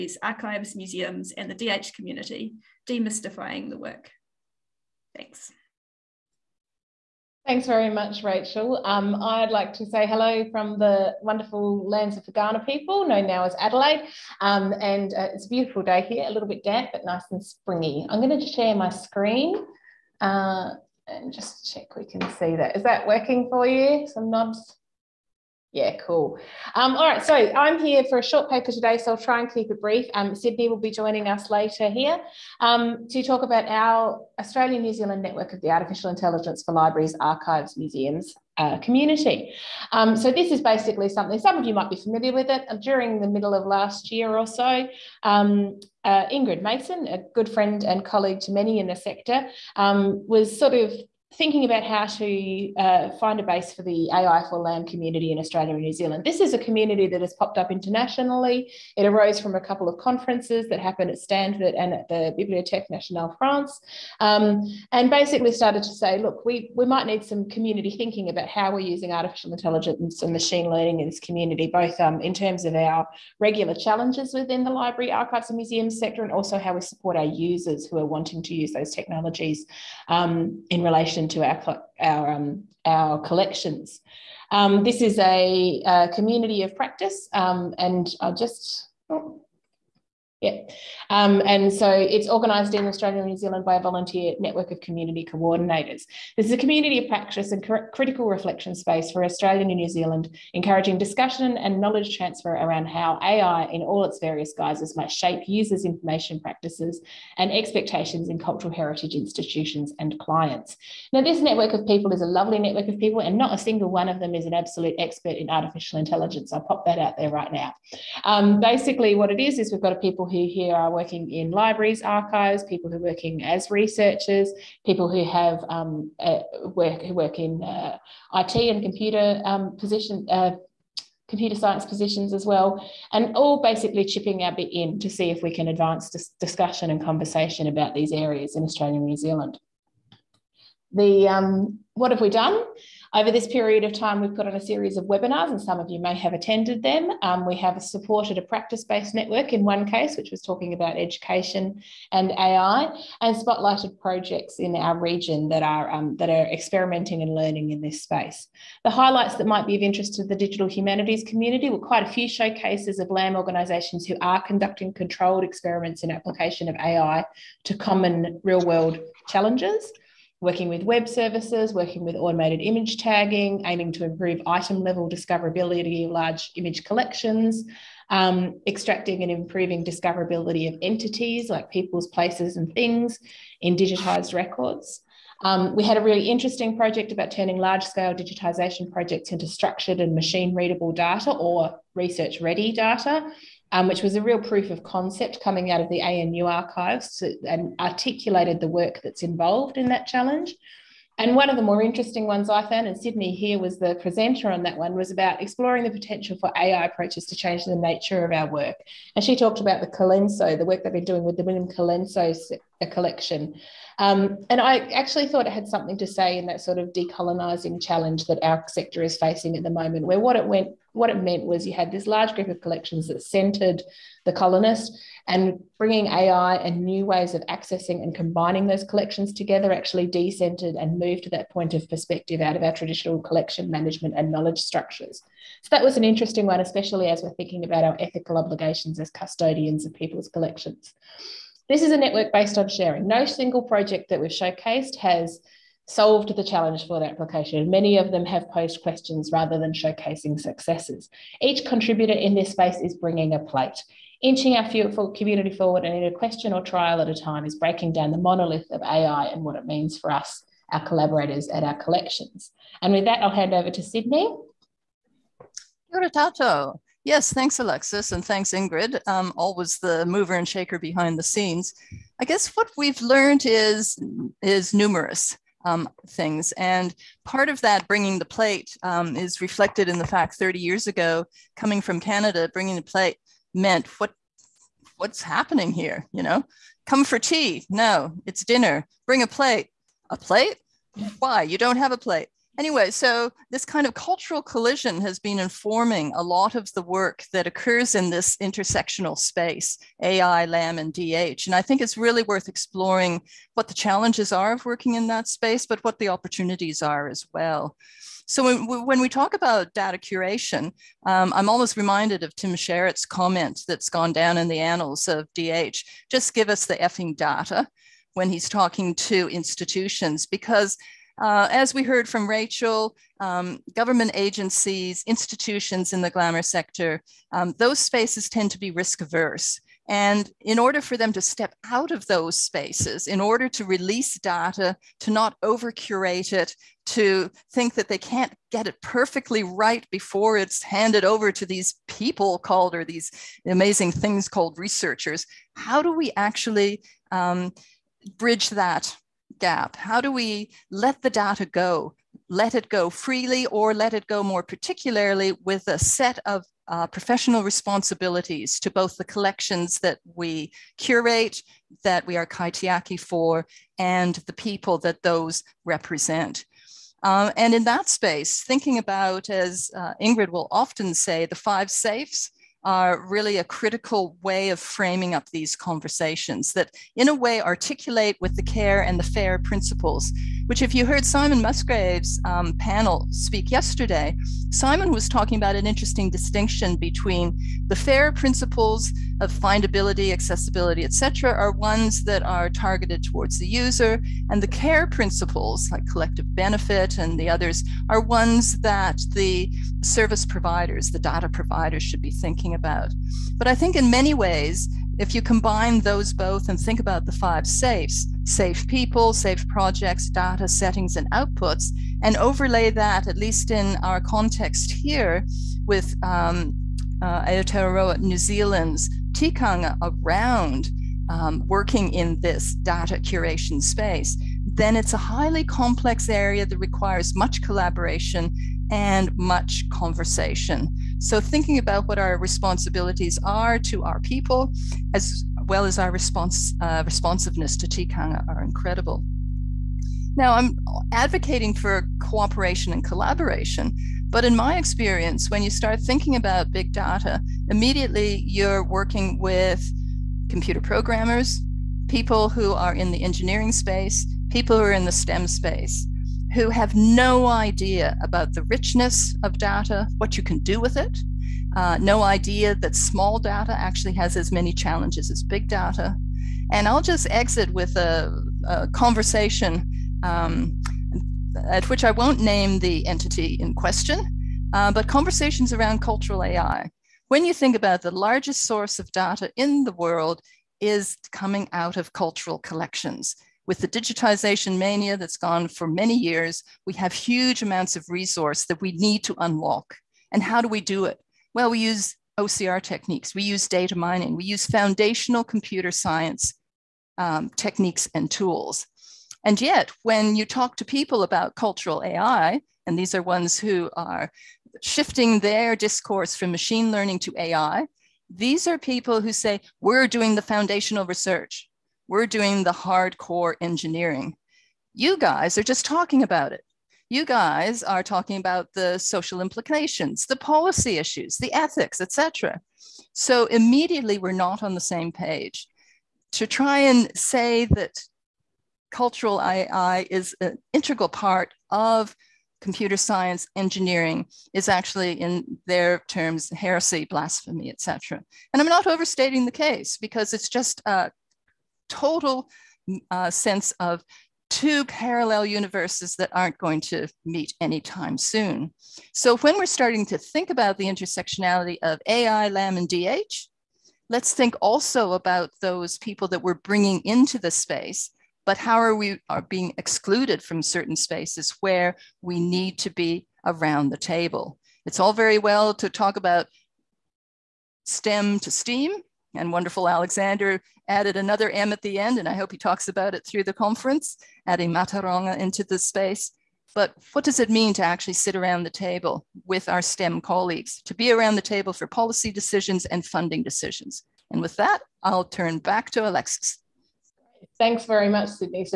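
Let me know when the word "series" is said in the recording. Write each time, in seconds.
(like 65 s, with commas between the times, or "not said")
144 s.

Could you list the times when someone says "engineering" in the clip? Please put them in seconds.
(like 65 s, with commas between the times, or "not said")
453 s, 513 s, 533 s.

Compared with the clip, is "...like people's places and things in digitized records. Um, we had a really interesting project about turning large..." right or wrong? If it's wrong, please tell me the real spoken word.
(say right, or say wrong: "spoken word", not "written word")
right.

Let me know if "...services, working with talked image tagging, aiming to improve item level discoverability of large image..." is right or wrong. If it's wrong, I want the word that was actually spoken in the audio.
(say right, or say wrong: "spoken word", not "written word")
wrong: "automated", not "talked".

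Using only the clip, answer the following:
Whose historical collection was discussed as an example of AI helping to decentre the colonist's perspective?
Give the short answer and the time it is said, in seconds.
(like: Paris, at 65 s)
William Colenso, at 211 s.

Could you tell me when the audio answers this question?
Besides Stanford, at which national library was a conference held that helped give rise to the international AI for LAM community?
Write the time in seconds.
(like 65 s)
62 s.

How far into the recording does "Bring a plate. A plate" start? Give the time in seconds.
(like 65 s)
289 s.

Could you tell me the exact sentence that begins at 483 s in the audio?
With the digitization mania that's gone for many years, we have huge amounts of resource that we need to unlock.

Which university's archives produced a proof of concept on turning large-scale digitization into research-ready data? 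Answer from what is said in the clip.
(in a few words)
ANU.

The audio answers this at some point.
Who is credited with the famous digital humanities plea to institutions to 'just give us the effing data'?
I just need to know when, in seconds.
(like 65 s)
312 s.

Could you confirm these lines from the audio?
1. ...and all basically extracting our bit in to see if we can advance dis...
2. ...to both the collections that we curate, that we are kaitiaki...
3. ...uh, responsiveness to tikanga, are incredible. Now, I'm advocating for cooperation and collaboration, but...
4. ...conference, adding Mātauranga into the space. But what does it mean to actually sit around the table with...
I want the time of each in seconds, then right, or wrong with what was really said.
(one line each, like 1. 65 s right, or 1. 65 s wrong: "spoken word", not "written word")
1. 133 s wrong: "chipping", not "extracting"
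2. 358 s right
3. 436 s right
4. 573 s right.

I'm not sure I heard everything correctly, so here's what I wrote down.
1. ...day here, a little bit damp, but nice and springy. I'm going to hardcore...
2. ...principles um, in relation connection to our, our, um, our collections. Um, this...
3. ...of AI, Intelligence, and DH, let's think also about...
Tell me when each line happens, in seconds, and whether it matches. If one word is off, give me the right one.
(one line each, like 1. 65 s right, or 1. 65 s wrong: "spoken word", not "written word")
1. 15 s wrong: "share", not "hardcore"
2. 78 s wrong: "technologies", not "principles"
3. 551 s wrong: "LAM", not "Intelligence".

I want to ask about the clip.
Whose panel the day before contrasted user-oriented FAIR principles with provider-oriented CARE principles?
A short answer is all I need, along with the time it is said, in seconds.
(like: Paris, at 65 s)
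Simon Musgrave, at 381 s.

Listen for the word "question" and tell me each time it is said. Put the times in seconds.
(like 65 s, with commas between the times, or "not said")
248 s, 256 s, 473 s.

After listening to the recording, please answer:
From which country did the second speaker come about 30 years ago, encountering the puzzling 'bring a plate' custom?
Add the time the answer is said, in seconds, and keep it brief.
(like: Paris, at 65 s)
Canada, at 282 s.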